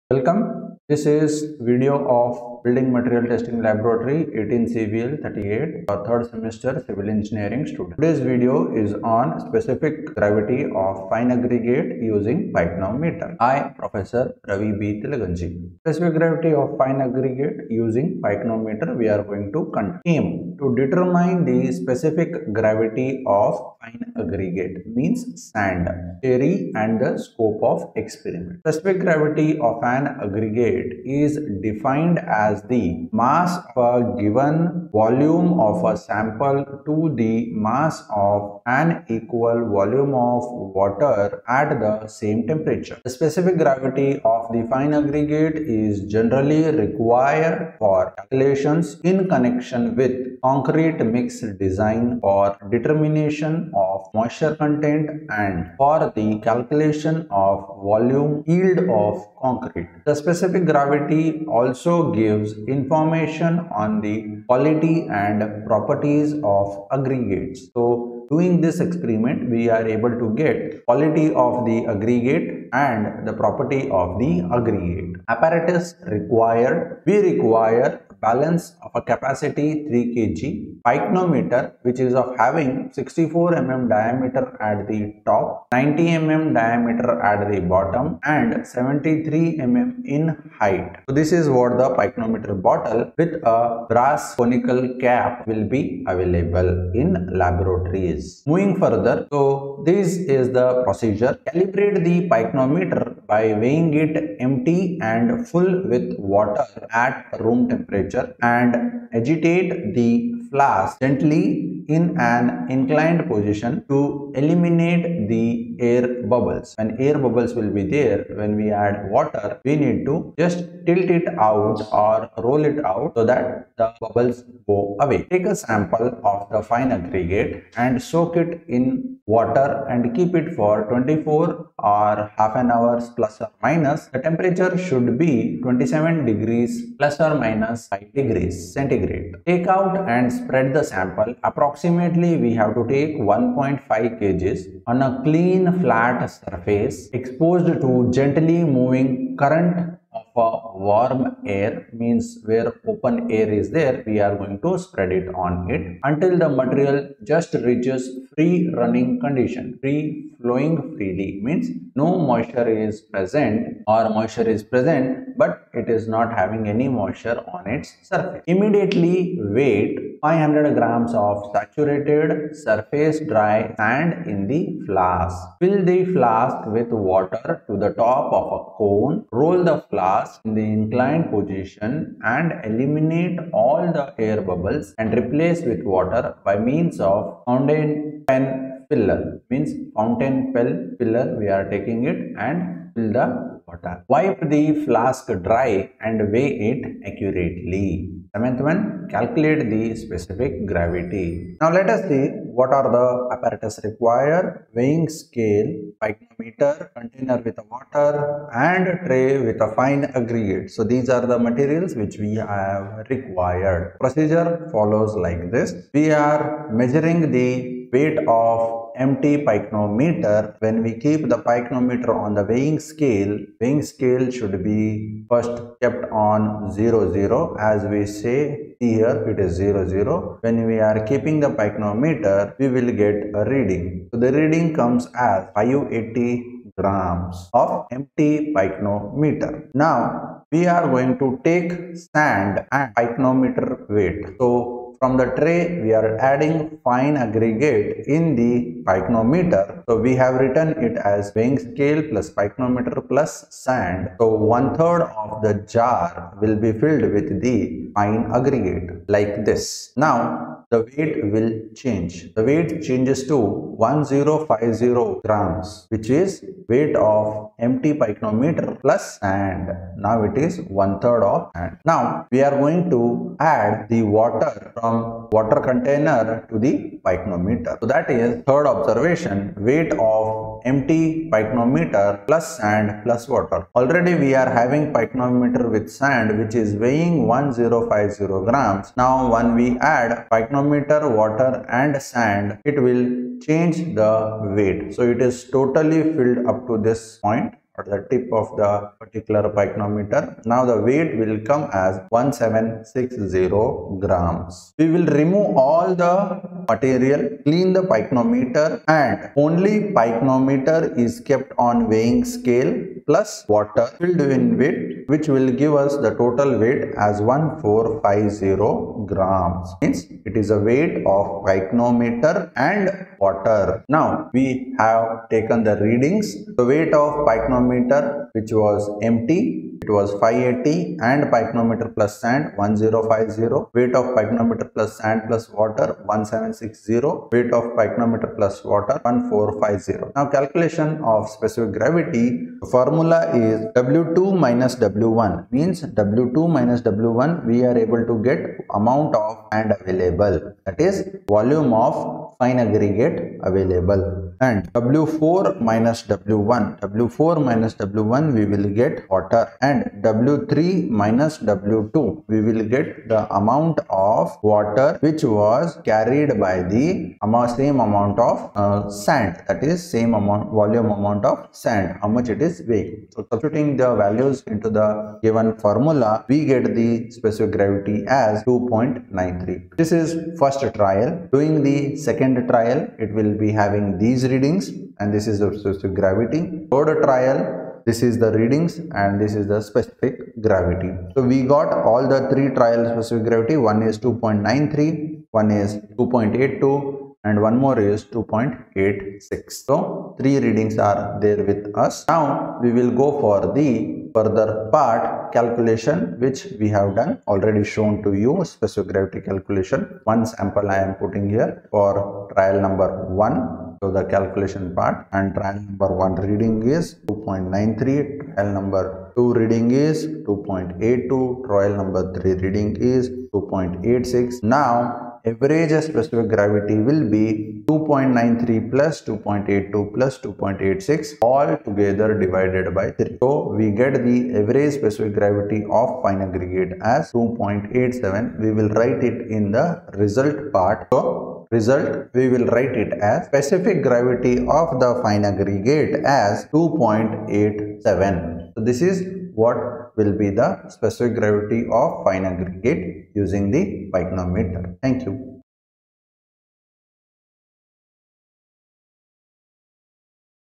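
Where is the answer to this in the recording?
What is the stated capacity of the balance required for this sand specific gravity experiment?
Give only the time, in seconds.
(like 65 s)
79 s.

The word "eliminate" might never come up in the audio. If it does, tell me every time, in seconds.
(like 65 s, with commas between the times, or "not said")
114 s, 182 s.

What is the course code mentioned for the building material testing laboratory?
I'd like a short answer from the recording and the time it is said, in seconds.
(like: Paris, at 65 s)
18 CVL 38, at 4 s.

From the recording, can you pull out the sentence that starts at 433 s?
So we get the average specific gravity of fine aggregate as 2.87.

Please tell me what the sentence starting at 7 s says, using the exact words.
Today's video is on specific gravity of fine aggregate using pycnometer.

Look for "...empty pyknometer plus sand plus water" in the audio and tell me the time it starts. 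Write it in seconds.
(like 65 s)
280 s.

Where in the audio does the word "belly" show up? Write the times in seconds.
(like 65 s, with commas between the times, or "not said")
not said.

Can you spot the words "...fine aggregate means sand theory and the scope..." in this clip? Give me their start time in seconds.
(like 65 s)
23 s.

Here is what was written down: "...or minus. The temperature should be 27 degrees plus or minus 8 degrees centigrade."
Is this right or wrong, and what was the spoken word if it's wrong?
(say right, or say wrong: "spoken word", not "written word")
wrong: "5", not "8".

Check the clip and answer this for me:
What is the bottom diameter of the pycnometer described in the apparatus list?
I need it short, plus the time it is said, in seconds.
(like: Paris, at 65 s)
90 mm, at 85 s.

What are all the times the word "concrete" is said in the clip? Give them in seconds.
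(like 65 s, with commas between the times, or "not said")
50 s, 59 s.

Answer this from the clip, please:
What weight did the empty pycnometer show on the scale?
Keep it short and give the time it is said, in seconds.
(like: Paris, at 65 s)
580 grams, at 235 s.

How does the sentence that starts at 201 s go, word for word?
Now let us see what are the apparatus required.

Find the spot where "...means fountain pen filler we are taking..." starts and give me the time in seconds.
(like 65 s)
189 s.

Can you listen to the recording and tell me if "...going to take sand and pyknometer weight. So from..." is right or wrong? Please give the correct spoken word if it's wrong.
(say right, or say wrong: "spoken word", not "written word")
right.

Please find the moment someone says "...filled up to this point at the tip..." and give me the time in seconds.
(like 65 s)
296 s.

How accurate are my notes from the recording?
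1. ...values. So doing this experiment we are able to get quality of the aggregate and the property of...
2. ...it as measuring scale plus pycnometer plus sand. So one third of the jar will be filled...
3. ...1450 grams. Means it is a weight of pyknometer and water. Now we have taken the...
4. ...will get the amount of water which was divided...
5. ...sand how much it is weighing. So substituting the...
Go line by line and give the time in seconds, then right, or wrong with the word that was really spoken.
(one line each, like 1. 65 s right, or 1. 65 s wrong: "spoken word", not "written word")
1. 66 s wrong: "aggregates", not "values"
2. 250 s wrong: "weighing", not "measuring"
3. 317 s right
4. 362 s wrong: "carried", not "divided"
5. 371 s right.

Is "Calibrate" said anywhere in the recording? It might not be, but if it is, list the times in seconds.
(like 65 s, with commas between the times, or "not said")
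101 s.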